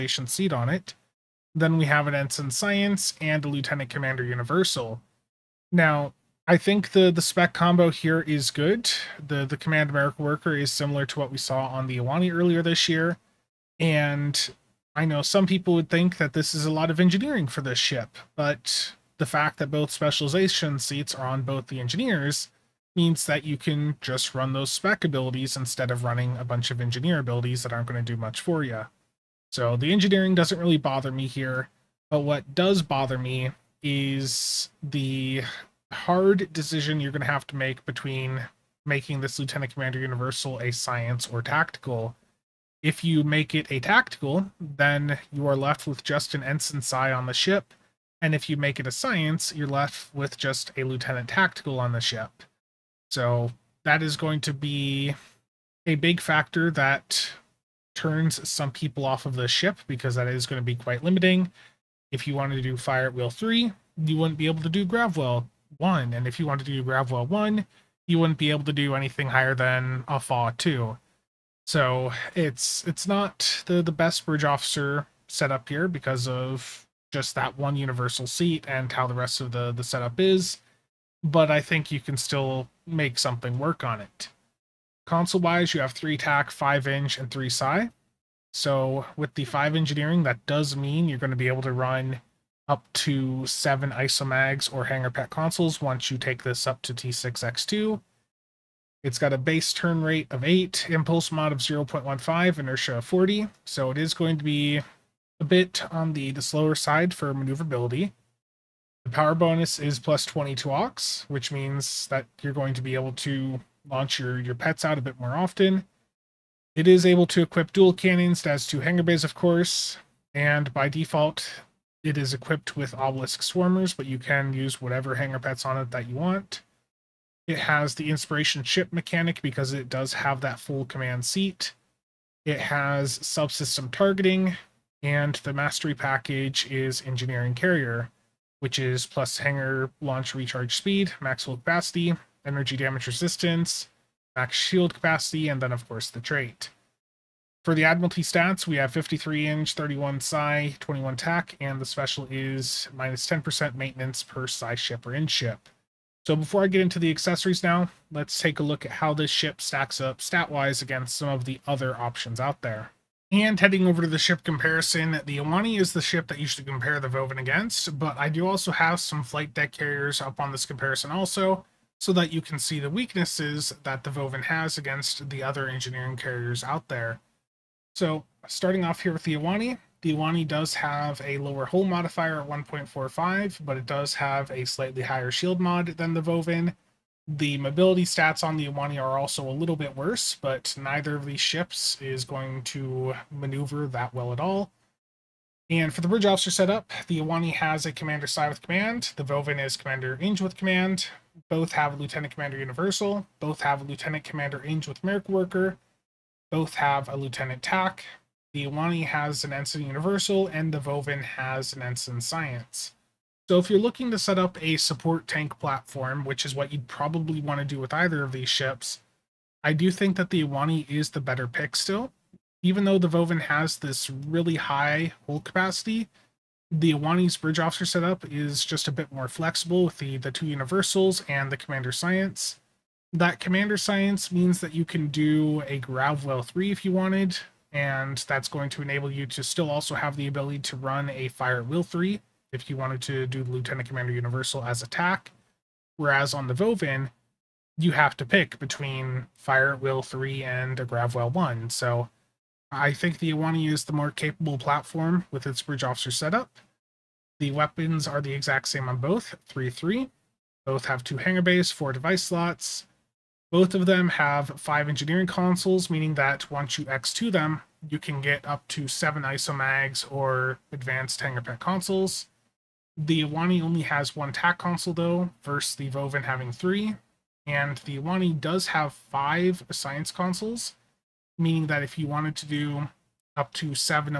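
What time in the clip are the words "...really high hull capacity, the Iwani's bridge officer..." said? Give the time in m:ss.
3:44.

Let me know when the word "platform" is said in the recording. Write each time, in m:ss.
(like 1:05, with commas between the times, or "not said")
3:35, 4:14.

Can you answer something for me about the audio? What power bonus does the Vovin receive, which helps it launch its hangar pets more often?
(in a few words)
+22 aux.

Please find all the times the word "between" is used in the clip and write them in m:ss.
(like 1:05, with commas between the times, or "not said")
0:37, 4:08.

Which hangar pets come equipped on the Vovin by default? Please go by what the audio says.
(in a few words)
Obelisk swarmers.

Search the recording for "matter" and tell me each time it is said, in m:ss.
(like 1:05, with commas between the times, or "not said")
not said.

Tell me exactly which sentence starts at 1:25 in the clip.
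Console wise, you have three tac, five eng, and three sci.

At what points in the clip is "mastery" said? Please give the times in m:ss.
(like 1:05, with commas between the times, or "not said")
2:15.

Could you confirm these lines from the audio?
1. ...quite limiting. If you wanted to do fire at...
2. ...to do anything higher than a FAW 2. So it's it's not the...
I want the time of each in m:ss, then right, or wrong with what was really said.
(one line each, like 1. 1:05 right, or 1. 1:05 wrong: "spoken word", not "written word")
1. 1:00 right
2. 1:08 right.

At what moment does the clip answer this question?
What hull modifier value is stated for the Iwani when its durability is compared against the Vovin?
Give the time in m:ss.
3:02.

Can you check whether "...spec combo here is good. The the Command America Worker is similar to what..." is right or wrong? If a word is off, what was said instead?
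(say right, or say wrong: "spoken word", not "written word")
right.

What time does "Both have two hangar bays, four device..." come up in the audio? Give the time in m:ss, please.
4:20.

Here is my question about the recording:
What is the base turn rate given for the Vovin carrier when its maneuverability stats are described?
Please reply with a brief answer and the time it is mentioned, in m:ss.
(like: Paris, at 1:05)
8, at 1:39.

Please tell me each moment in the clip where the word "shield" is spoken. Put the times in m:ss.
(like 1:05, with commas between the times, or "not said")
2:24, 3:05.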